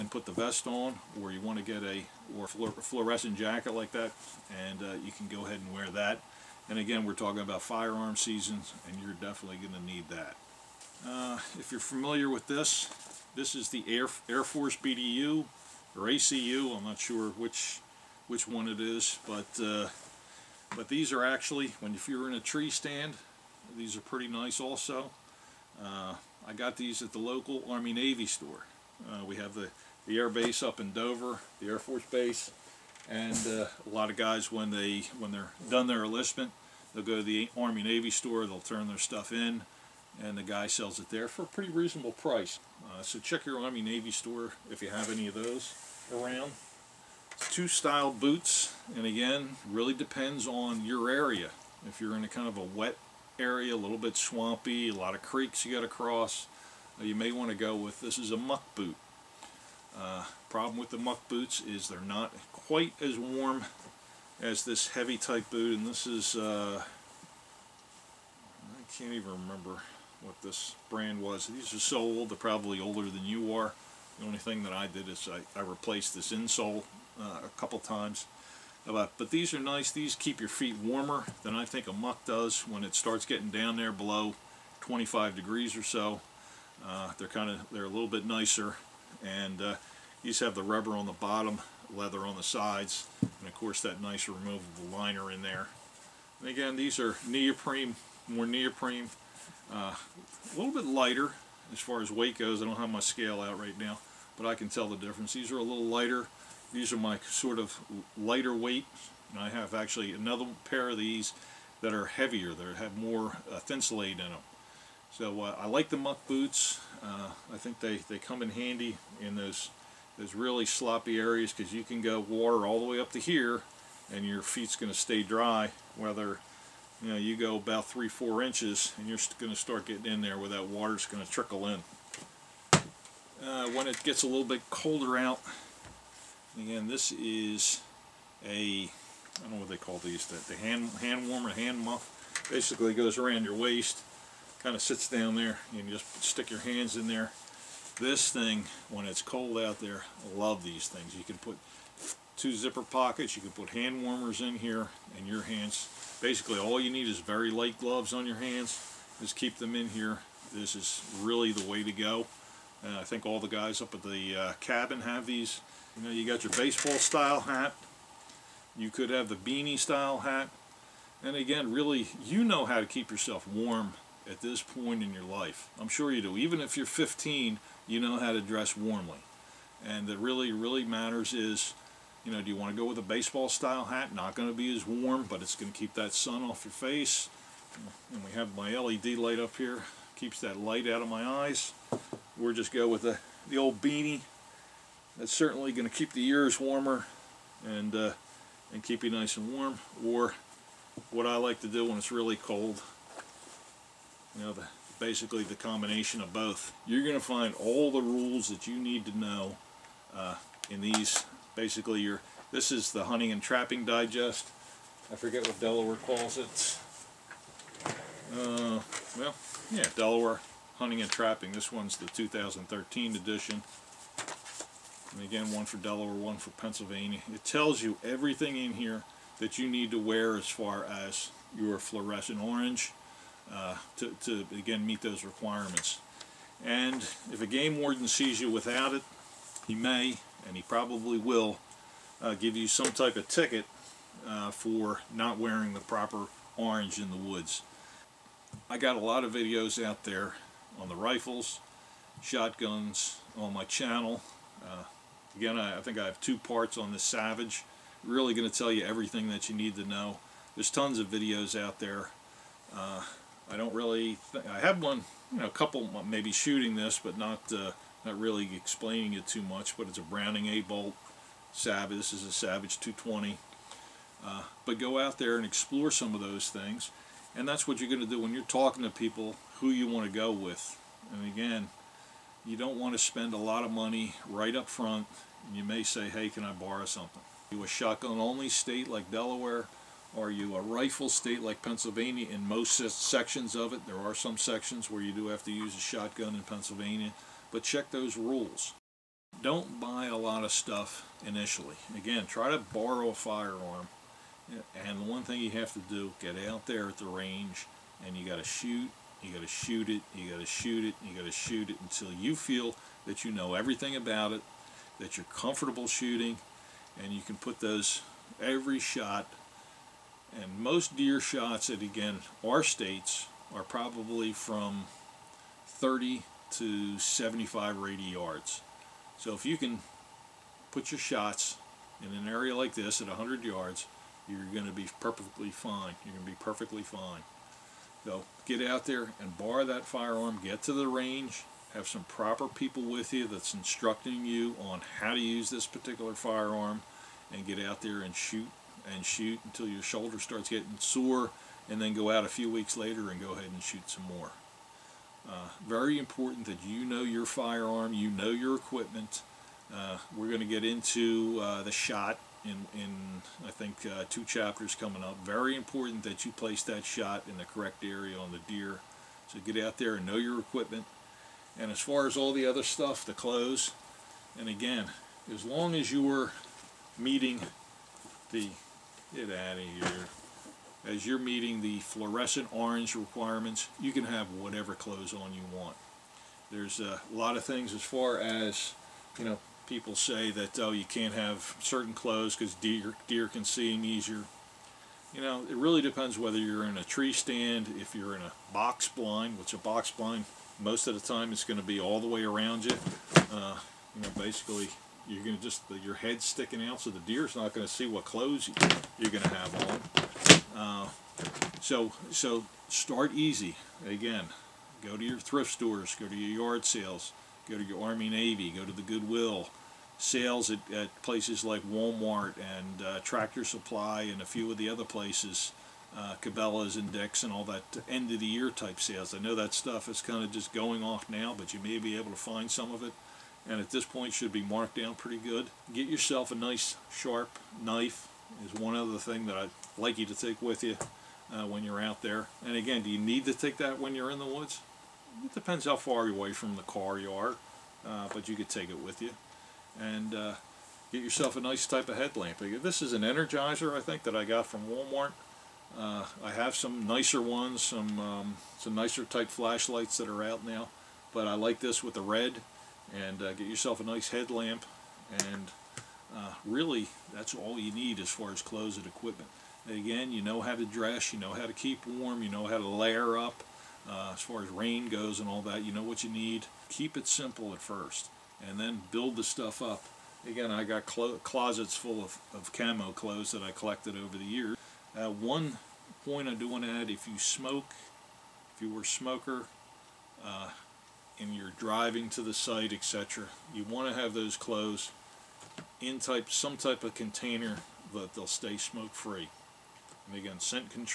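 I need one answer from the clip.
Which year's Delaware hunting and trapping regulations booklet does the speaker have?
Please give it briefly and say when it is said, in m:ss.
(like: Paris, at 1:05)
2013, at 3:42.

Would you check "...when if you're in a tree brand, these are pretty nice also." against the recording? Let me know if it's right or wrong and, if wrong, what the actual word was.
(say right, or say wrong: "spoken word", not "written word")
wrong: "stand", not "brand".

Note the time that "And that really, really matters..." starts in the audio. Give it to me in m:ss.
2:59.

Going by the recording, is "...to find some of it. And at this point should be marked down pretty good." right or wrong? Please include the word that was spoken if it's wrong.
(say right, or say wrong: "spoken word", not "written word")
right.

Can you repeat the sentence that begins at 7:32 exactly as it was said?
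Uh, this is an Energizer, I think, that I got from Walmart.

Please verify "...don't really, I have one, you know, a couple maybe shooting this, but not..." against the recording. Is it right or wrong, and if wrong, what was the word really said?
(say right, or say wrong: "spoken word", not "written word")
right.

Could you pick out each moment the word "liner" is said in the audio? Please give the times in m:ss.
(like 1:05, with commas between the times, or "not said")
1:34.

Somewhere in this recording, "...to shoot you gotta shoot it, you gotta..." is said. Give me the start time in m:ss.
5:08.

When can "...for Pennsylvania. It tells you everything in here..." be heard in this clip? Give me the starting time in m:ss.
3:46.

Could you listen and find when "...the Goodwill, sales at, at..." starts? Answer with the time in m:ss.
6:58.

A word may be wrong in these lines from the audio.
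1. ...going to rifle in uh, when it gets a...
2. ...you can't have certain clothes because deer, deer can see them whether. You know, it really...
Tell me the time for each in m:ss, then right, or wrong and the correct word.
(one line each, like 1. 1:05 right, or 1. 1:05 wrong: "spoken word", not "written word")
1. 2:11 wrong: "trickle", not "rifle"
2. 6:30 wrong: "easier", not "whether".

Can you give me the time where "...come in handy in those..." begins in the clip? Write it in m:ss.
1:58.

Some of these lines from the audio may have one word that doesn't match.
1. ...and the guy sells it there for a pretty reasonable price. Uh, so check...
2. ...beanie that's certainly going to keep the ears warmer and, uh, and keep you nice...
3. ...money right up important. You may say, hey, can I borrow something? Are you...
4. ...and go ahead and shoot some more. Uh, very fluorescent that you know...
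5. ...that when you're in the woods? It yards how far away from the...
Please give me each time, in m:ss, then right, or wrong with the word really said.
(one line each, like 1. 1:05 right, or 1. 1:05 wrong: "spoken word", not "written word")
1. 0:40 right
2. 3:13 right
3. 4:43 wrong: "front", not "important"
4. 5:53 wrong: "important", not "fluorescent"
5. 7:23 wrong: "depends", not "yards".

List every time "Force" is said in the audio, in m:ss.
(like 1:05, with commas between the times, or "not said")
0:14, 0:31.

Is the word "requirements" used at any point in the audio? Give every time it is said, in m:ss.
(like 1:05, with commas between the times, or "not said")
3:55, 6:22.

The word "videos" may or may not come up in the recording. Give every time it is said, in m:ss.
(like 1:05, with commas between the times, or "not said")
4:09, 4:21.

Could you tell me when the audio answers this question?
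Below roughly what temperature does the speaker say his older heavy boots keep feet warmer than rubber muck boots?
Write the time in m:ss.
1:24.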